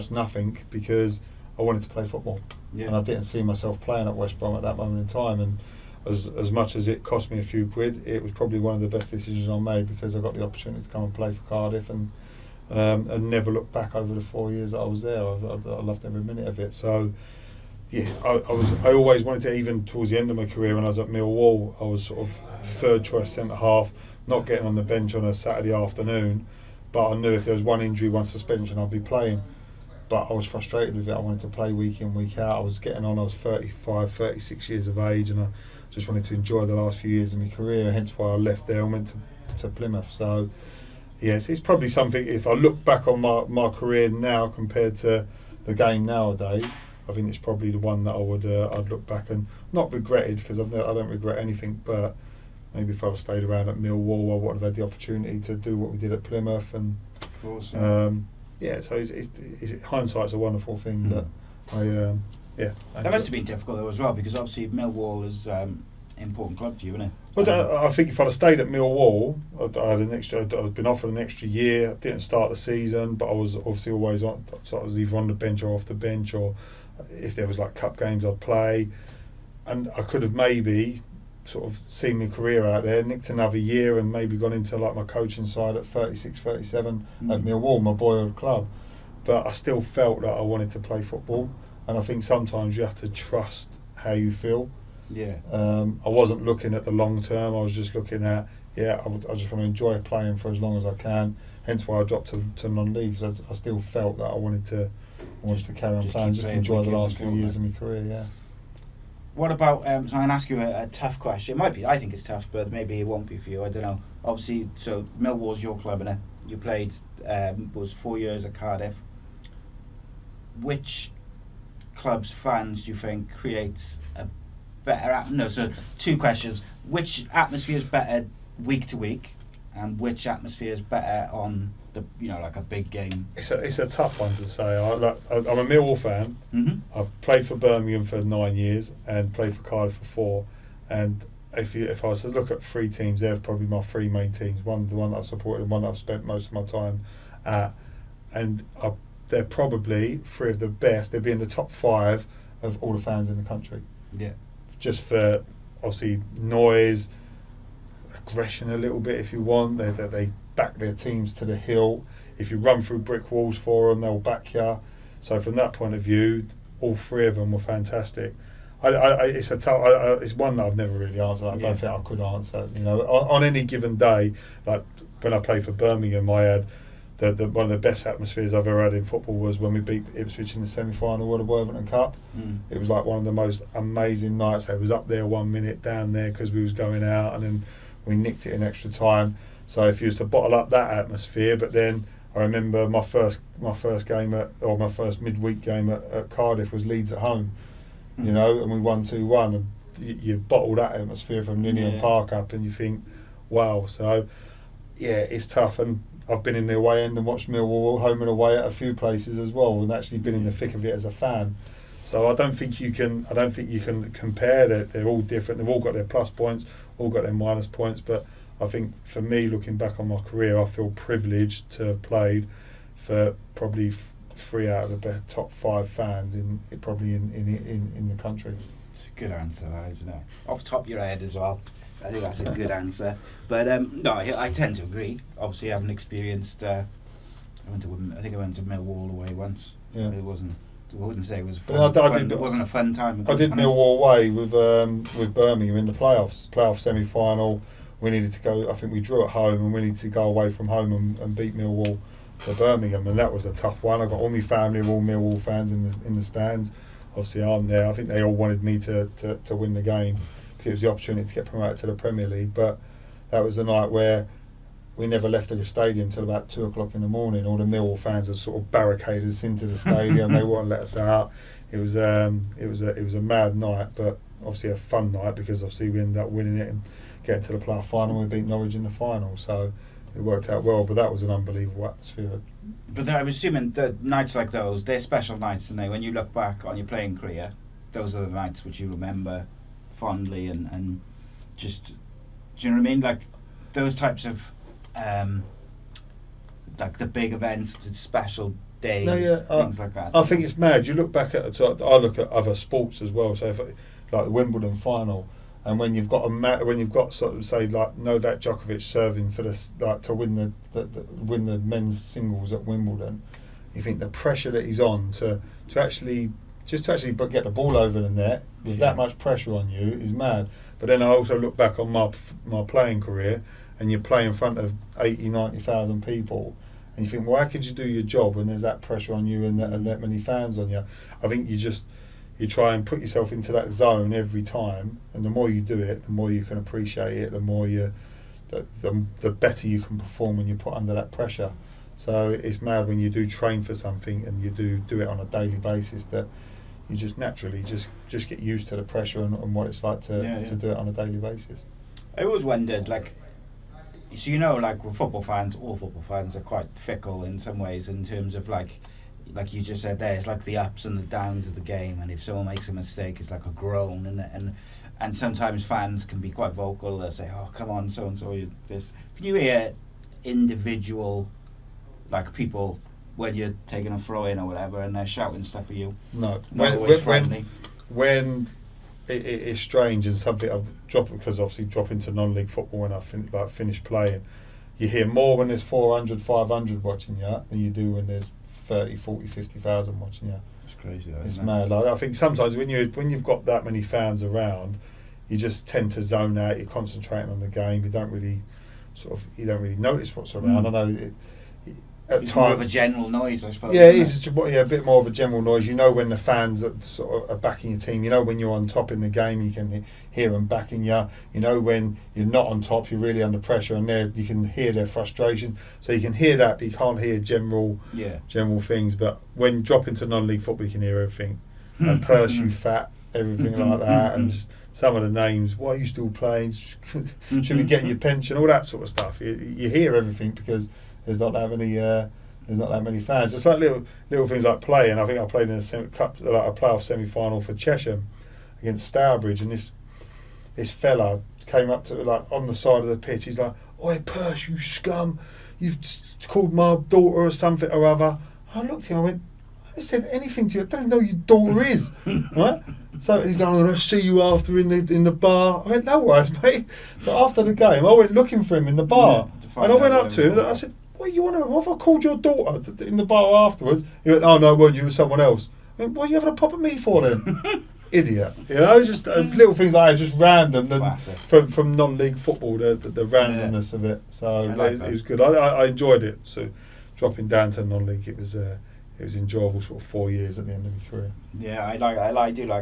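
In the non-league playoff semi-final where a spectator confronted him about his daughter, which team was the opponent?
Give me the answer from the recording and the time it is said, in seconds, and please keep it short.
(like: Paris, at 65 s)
Stourbridge, at 438 s.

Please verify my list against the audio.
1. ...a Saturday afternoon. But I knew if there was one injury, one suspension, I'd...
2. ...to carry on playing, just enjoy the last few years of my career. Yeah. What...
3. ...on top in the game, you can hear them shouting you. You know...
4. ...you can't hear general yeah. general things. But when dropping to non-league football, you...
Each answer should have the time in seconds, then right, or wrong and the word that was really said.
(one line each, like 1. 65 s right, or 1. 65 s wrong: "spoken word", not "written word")
1. 25 s right
2. 105 s right
3. 408 s wrong: "backing", not "shouting"
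4. 416 s right.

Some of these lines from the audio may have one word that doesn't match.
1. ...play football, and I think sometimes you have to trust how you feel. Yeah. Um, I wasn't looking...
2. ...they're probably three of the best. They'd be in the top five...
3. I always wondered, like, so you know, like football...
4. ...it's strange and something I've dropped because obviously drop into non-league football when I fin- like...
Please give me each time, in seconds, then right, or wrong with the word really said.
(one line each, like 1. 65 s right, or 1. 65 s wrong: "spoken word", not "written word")
1. 90 s right
2. 149 s right
3. 352 s right
4. 379 s right.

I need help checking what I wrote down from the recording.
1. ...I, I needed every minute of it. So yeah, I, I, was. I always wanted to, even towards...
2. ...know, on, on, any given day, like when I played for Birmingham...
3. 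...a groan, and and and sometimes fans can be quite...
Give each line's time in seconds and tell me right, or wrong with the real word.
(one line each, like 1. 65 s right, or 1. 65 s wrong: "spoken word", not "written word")
1. 15 s wrong: "loved", not "needed"
2. 172 s right
3. 363 s right.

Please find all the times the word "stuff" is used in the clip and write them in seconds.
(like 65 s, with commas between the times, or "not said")
375 s, 428 s.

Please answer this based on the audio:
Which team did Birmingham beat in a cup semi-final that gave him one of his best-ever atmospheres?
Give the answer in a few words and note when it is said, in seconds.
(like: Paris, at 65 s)
Ipswich, at 180 s.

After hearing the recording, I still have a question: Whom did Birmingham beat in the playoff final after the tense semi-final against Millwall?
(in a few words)
Norwich.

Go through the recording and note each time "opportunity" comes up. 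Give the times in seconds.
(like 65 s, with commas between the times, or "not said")
10 s, 54 s, 260 s.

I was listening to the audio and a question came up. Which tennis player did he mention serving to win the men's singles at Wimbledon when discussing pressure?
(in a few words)
Novak Djokovic.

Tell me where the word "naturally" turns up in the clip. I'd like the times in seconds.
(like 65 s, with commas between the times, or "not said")
347 s.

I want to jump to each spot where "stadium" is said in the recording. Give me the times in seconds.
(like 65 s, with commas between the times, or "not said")
265 s, 269 s.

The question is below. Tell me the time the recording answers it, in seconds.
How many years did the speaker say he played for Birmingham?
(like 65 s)
138 s.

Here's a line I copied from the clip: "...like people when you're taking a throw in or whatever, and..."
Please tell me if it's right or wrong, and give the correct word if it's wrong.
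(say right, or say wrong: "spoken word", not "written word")
right.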